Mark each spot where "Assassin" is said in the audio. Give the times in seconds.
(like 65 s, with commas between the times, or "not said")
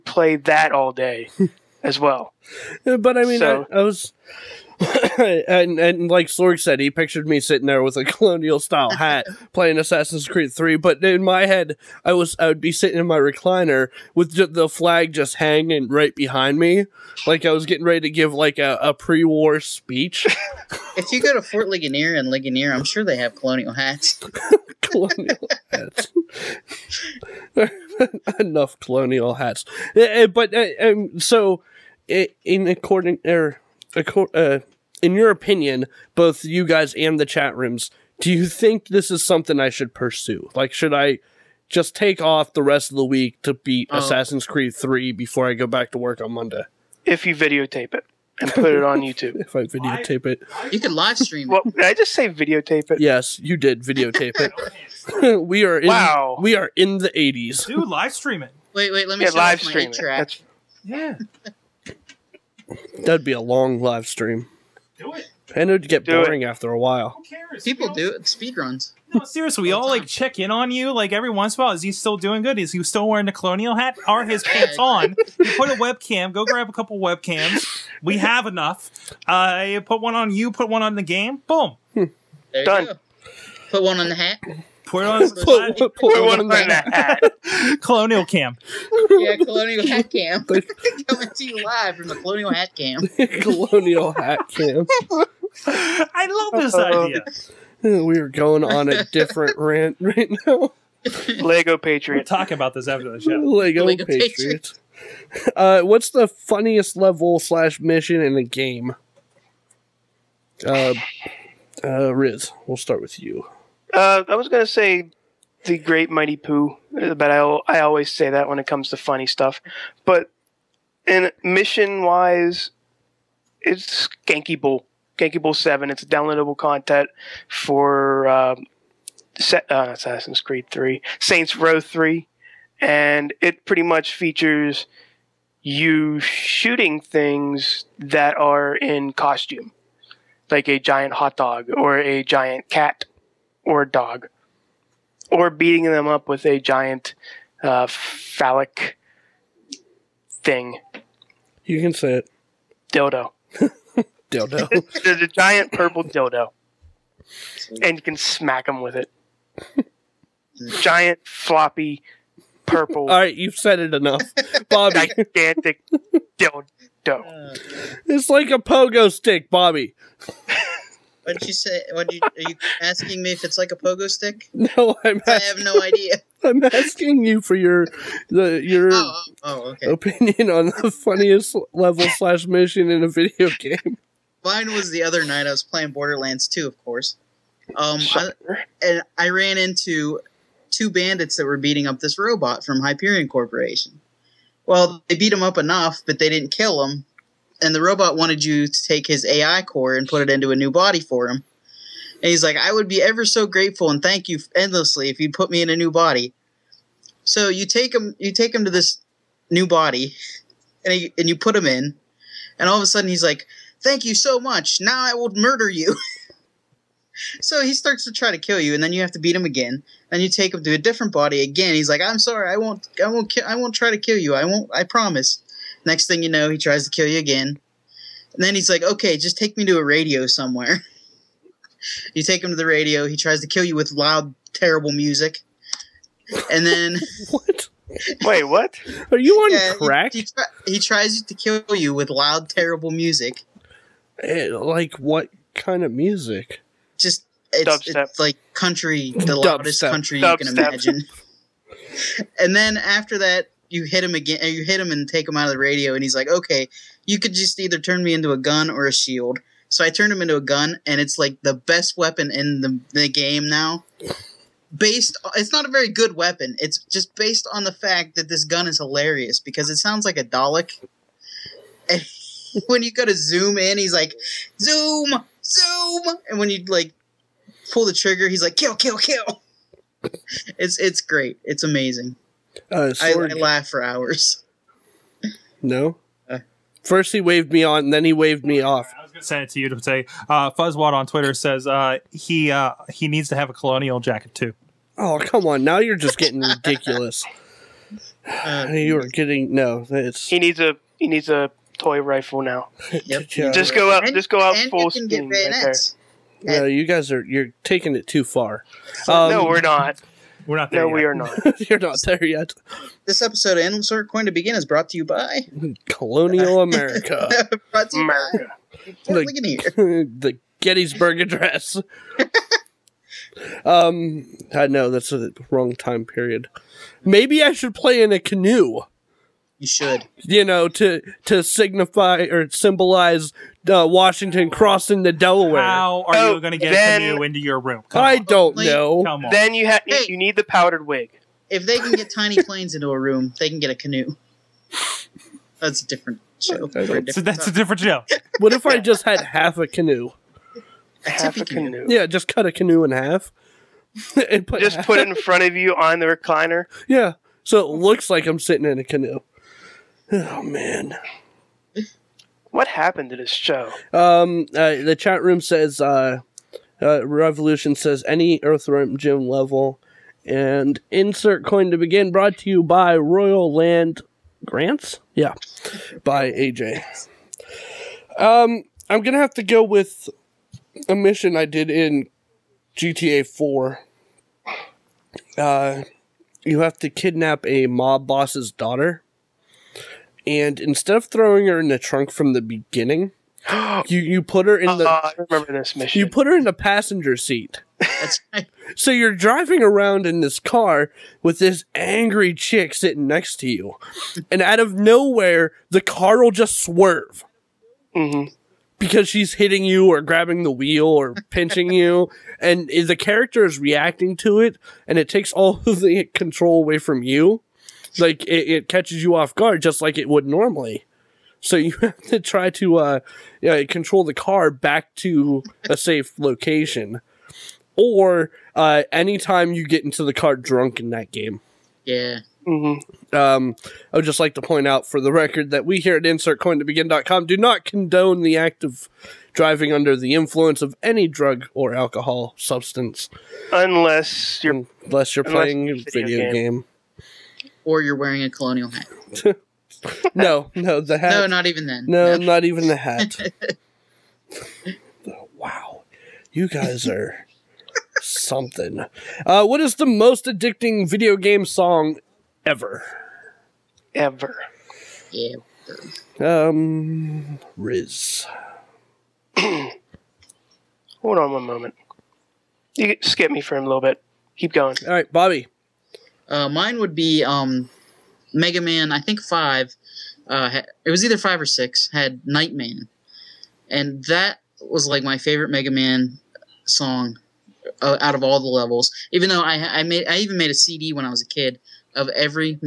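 9 s, 43 s, 129 s.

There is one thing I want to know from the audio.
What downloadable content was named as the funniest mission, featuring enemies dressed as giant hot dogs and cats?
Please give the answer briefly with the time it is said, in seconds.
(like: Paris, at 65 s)
Genki Bowl Seven, at 125 s.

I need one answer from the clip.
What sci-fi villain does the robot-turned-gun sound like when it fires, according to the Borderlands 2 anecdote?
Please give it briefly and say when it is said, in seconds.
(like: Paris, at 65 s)
A Dalek, at 270 s.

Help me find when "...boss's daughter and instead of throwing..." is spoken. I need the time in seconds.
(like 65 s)
388 s.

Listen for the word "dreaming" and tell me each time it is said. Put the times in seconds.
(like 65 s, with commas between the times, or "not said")
not said.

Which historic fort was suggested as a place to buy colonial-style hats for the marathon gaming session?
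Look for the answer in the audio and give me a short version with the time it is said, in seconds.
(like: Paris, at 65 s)
Fort Ligonier, at 21 s.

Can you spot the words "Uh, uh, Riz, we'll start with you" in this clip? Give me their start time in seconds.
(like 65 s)
110 s.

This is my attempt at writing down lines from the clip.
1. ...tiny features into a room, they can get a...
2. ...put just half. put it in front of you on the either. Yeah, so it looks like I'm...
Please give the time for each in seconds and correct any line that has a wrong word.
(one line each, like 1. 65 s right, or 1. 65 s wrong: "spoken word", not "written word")
1. 342 s wrong: "planes", not "features"
2. 354 s wrong: "recliner", not "either".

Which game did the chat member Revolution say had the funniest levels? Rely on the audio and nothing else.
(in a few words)
Earthworm Jim.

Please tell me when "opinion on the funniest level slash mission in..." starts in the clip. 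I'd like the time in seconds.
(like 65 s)
179 s.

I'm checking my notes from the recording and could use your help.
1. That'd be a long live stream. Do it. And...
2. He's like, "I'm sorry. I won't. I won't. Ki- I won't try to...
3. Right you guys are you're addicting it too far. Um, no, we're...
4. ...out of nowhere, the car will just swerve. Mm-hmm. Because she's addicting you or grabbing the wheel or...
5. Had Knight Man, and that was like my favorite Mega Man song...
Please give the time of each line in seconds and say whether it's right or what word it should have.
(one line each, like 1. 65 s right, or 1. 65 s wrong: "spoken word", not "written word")
1. 62 s right
2. 221 s right
3. 305 s wrong: "taking", not "addicting"
4. 404 s wrong: "hitting", not "addicting"
5. 481 s right.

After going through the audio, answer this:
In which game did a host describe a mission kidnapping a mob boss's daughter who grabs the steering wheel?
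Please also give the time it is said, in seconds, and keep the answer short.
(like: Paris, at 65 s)
GTA 4, at 382 s.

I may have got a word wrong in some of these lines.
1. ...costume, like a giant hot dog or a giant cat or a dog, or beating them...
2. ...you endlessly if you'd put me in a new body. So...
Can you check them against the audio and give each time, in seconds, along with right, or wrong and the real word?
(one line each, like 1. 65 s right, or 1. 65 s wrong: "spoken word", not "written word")
1. 139 s right
2. 204 s right.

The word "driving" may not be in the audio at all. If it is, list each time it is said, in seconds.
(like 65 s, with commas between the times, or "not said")
399 s, 439 s.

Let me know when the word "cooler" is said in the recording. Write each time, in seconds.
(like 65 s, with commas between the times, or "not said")
not said.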